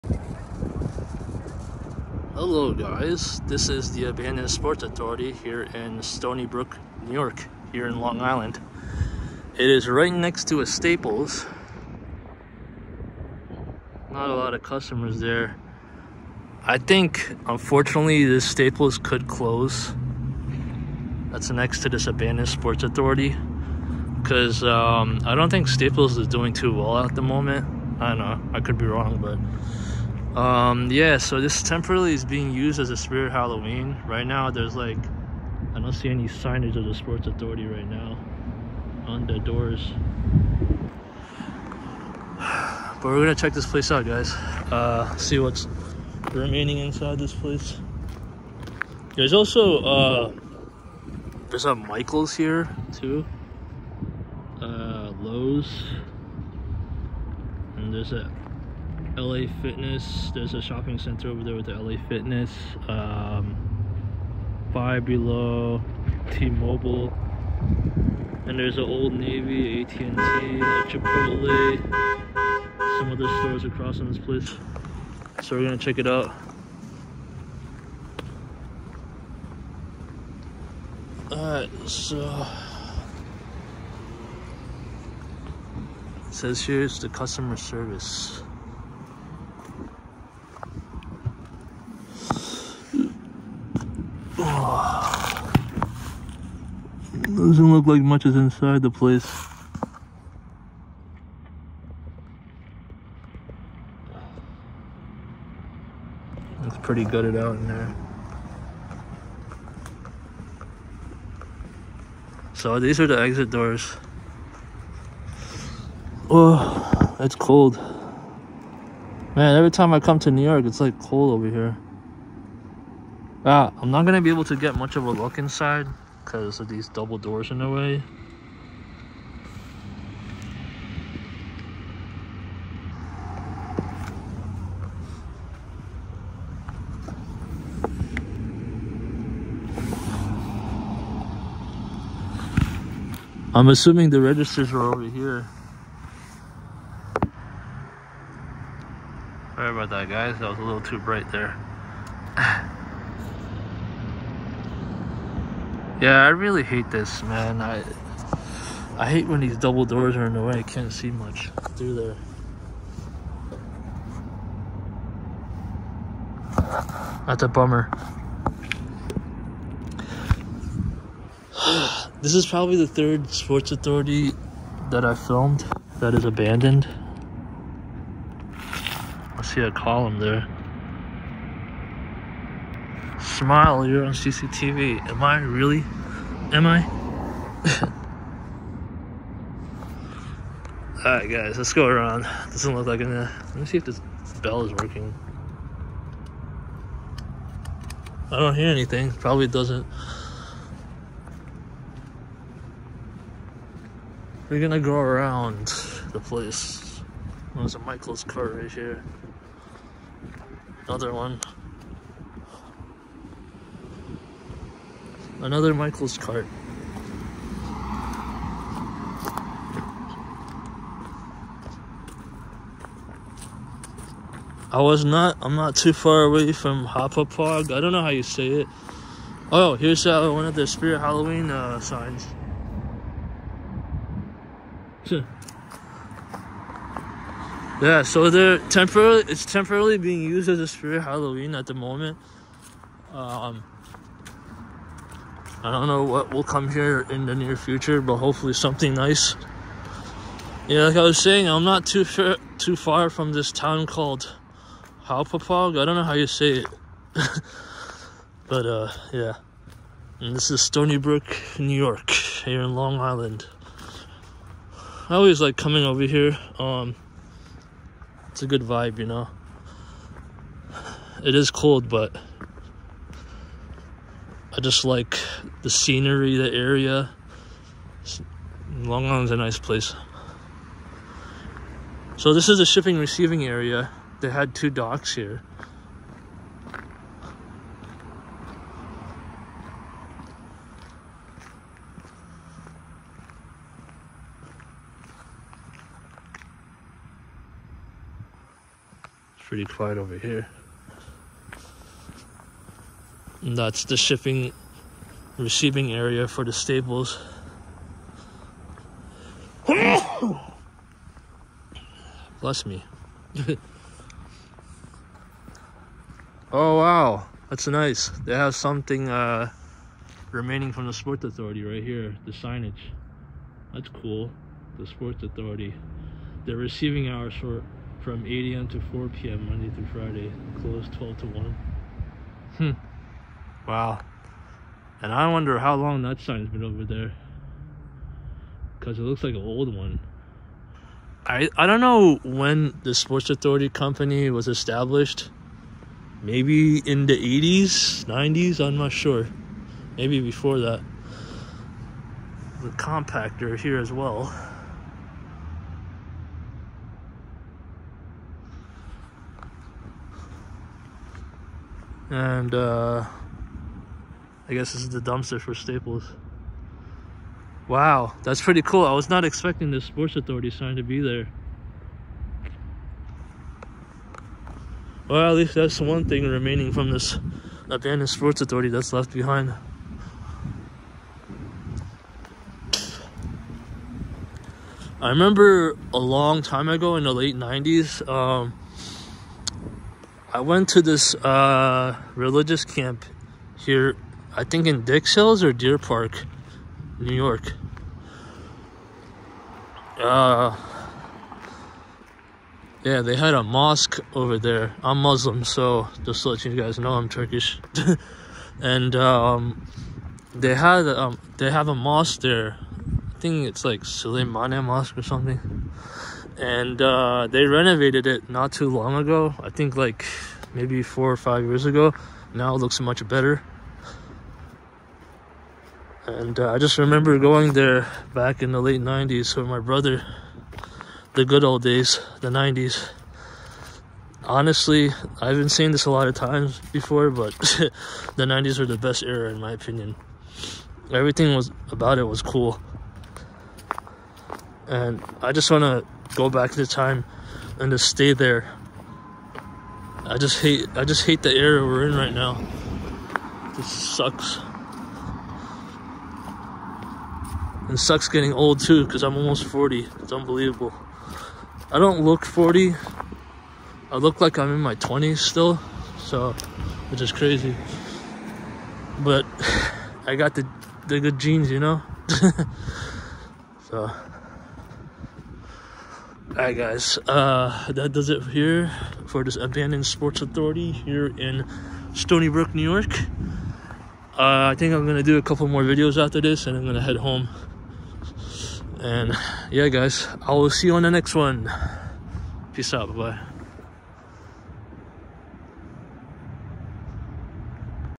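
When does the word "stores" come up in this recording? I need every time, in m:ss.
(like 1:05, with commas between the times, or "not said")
1:13.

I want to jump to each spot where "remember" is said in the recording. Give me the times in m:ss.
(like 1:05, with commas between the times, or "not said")
6:25, 7:06.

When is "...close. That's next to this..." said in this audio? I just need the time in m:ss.
0:19.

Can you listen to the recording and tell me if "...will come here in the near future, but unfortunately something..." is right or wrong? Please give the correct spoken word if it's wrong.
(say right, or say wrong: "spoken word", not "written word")
wrong: "hopefully", not "unfortunately".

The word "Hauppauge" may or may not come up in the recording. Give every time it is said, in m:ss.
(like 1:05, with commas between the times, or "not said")
3:46, 4:15.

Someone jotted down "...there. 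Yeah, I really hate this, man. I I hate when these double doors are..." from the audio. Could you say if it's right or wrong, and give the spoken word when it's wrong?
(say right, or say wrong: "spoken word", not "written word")
right.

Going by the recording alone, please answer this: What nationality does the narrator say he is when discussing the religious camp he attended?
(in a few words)
Turkish.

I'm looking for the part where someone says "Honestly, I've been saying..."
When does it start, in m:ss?
7:14.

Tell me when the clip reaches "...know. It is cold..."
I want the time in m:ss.
4:29.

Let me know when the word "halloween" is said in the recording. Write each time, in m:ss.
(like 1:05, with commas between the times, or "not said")
0:33, 3:50, 4:01.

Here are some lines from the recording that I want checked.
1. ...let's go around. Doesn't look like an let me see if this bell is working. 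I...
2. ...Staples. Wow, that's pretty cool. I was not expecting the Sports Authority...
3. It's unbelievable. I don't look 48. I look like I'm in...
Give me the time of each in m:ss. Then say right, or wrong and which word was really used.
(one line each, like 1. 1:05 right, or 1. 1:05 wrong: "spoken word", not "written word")
1. 3:11 right
2. 6:05 right
3. 7:40 wrong: "40", not "48".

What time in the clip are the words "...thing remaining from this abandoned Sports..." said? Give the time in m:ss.
6:16.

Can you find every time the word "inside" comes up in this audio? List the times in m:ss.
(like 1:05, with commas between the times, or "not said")
0:46, 1:38, 2:05.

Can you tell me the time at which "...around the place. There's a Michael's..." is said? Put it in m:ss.
3:24.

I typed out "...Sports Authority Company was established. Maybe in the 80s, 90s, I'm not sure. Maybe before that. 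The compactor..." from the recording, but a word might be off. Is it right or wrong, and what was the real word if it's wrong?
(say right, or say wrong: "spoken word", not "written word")
right.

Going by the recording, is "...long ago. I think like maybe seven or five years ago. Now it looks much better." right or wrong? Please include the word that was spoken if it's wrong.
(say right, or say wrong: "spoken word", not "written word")
wrong: "four", not "seven".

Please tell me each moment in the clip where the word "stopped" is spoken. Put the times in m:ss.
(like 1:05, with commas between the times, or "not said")
not said.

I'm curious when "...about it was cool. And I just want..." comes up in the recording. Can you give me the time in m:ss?
7:21.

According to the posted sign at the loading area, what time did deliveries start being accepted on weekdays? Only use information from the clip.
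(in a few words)
8 a.m.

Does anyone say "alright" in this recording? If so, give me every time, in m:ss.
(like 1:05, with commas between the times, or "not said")
1:21, 3:11, 7:56.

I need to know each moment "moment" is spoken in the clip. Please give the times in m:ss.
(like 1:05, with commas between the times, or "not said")
0:27, 4:01.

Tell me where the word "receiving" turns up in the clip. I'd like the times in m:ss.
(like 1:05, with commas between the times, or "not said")
4:42, 5:05, 5:26.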